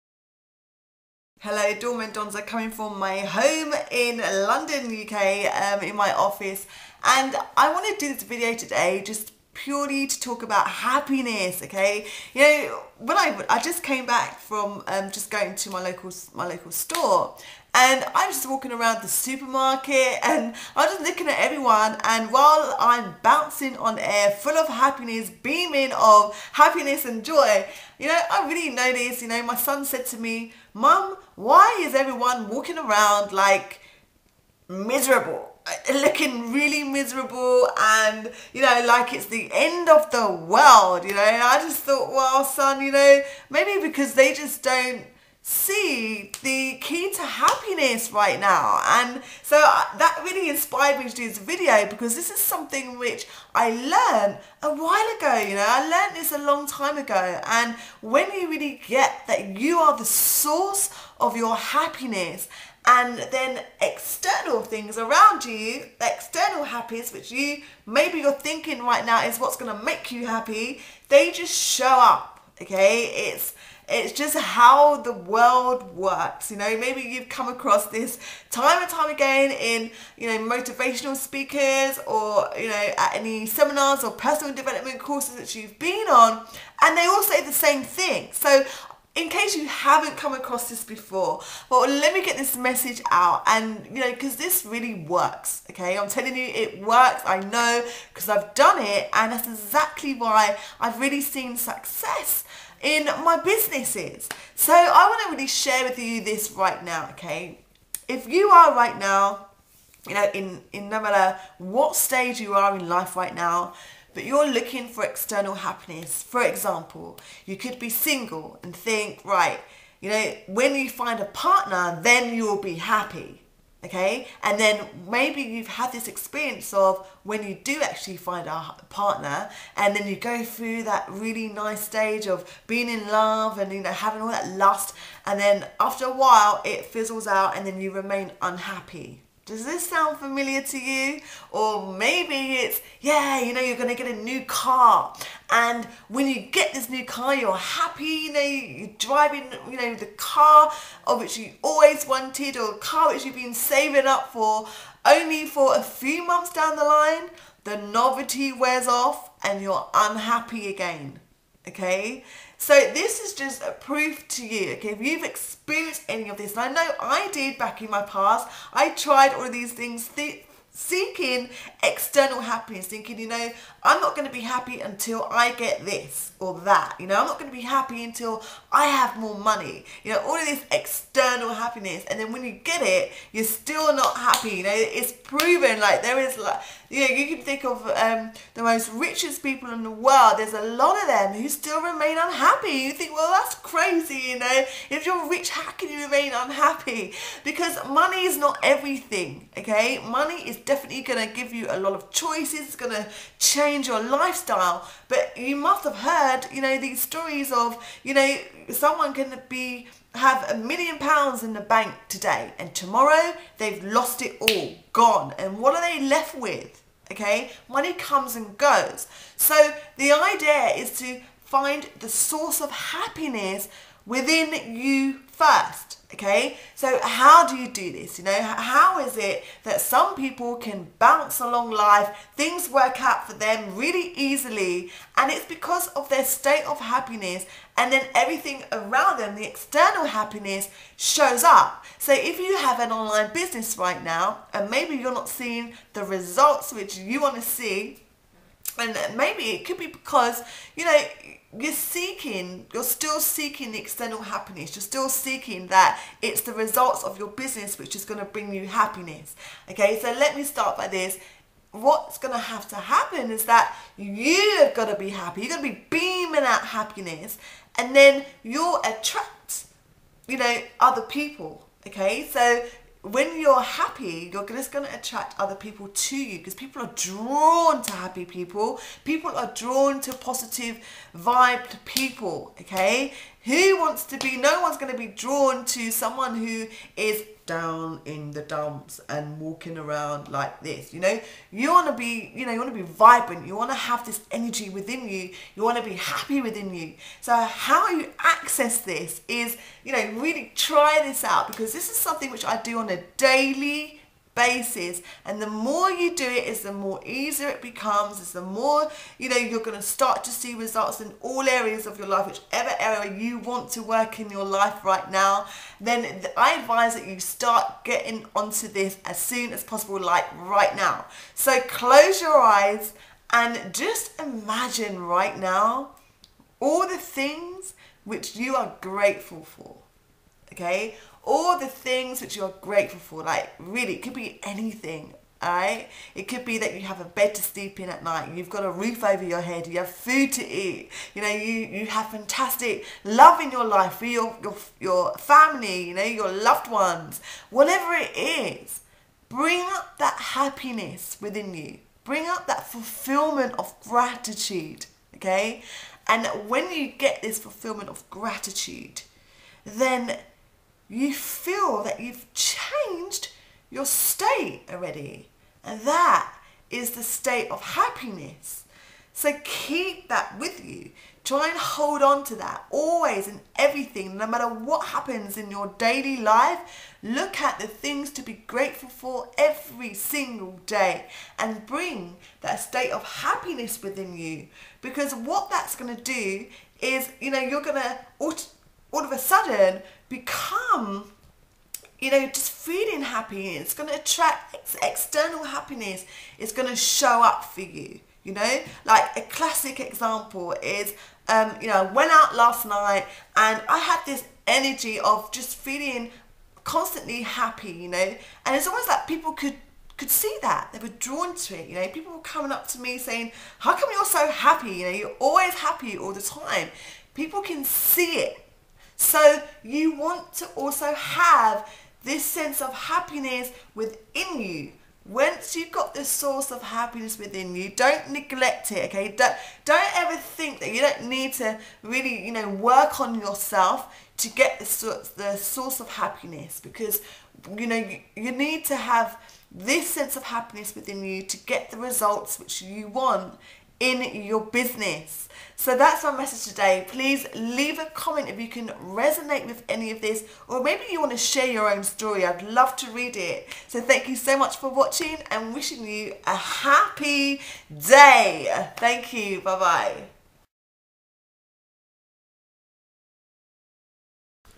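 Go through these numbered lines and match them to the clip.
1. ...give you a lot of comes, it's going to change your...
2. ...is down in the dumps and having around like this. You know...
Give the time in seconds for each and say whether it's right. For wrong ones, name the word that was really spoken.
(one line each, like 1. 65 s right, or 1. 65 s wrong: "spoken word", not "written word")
1. 201 s wrong: "choices", not "comes"
2. 286 s wrong: "walking", not "having".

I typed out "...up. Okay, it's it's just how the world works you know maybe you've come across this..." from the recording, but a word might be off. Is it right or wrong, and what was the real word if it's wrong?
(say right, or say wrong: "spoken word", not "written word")
right.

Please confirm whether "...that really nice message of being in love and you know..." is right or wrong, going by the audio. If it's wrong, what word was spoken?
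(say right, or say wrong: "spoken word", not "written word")
wrong: "stage", not "message".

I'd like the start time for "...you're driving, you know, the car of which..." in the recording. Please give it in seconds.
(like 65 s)
148 s.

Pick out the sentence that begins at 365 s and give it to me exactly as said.
And that is the state of happiness.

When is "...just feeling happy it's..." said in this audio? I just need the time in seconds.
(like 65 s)
392 s.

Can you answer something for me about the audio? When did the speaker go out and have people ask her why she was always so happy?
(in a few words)
Last night.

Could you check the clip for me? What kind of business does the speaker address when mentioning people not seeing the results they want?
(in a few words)
An online business.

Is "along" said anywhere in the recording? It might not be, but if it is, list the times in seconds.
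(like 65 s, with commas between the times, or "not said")
231 s.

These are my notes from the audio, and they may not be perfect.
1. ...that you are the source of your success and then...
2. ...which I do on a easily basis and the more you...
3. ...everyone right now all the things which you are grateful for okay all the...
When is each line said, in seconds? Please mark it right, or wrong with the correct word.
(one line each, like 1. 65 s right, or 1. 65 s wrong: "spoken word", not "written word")
1. 59 s wrong: "happiness", not "success"
2. 302 s wrong: "daily", not "easily"
3. 324 s wrong: "imagine", not "everyone".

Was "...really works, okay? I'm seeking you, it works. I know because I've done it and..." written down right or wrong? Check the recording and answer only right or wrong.
wrong.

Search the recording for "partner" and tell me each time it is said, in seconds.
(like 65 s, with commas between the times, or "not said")
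121 s, 128 s.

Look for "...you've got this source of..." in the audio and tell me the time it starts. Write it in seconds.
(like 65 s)
425 s.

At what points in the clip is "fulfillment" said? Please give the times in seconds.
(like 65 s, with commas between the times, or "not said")
352 s, 357 s.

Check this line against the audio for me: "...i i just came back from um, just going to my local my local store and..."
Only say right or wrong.
right.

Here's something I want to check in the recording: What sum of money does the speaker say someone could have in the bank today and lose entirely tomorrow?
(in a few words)
A million pounds.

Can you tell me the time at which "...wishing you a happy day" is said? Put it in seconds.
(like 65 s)
455 s.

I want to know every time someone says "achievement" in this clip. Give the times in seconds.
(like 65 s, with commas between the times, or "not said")
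not said.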